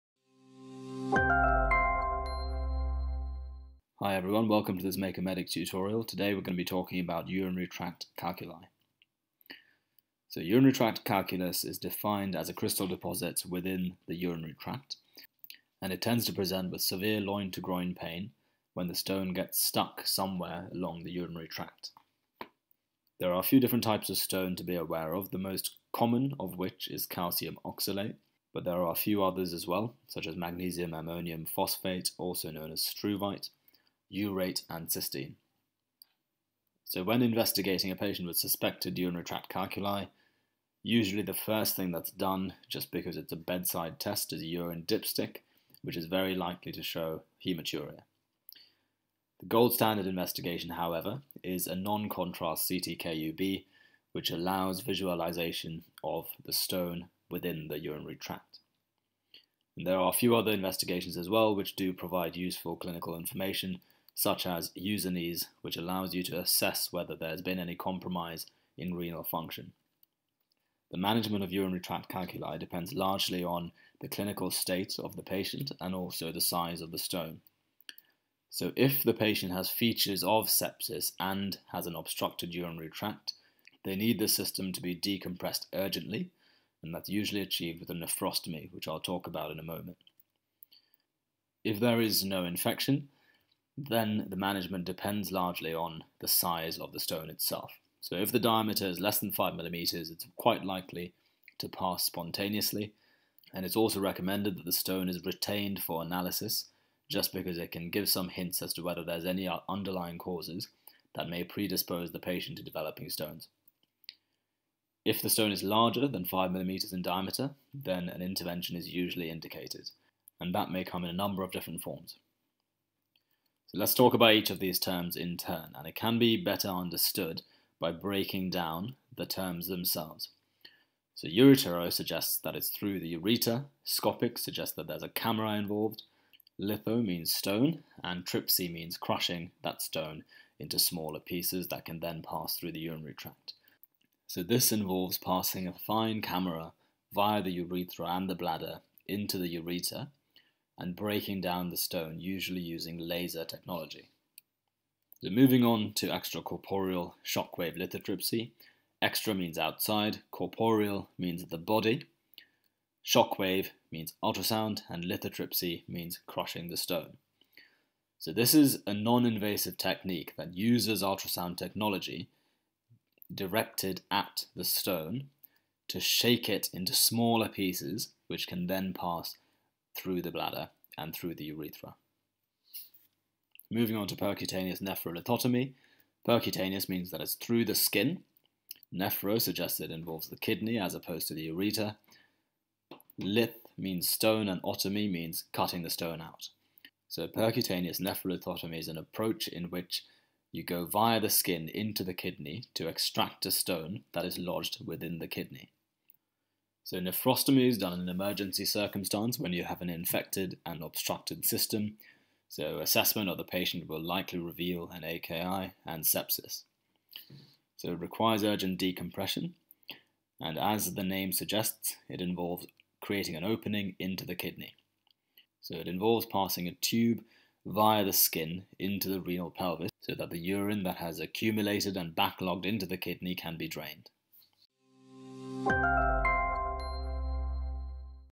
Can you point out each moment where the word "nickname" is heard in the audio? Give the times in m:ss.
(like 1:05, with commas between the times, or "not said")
not said.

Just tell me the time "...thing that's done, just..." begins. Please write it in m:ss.
0:41.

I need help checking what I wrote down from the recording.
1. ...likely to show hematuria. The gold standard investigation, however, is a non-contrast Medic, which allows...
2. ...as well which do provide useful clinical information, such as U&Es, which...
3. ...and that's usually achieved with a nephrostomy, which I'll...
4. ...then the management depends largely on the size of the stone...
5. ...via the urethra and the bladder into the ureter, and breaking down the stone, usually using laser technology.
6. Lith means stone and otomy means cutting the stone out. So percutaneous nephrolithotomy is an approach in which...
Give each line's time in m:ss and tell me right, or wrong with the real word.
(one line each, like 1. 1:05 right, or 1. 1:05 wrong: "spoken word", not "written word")
1. 0:46 wrong: "CTKUB", not "Medic"
2. 1:01 right
3. 1:26 right
4. 1:33 right
5. 2:27 right
6. 3:13 right.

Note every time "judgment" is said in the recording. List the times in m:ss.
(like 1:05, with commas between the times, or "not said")
not said.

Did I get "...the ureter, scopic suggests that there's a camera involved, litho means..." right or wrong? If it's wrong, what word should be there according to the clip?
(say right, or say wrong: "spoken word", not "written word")
right.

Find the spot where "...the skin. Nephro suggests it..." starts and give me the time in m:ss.
3:07.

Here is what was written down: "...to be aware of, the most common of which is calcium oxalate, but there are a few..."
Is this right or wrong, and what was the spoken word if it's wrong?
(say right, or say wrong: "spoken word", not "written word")
right.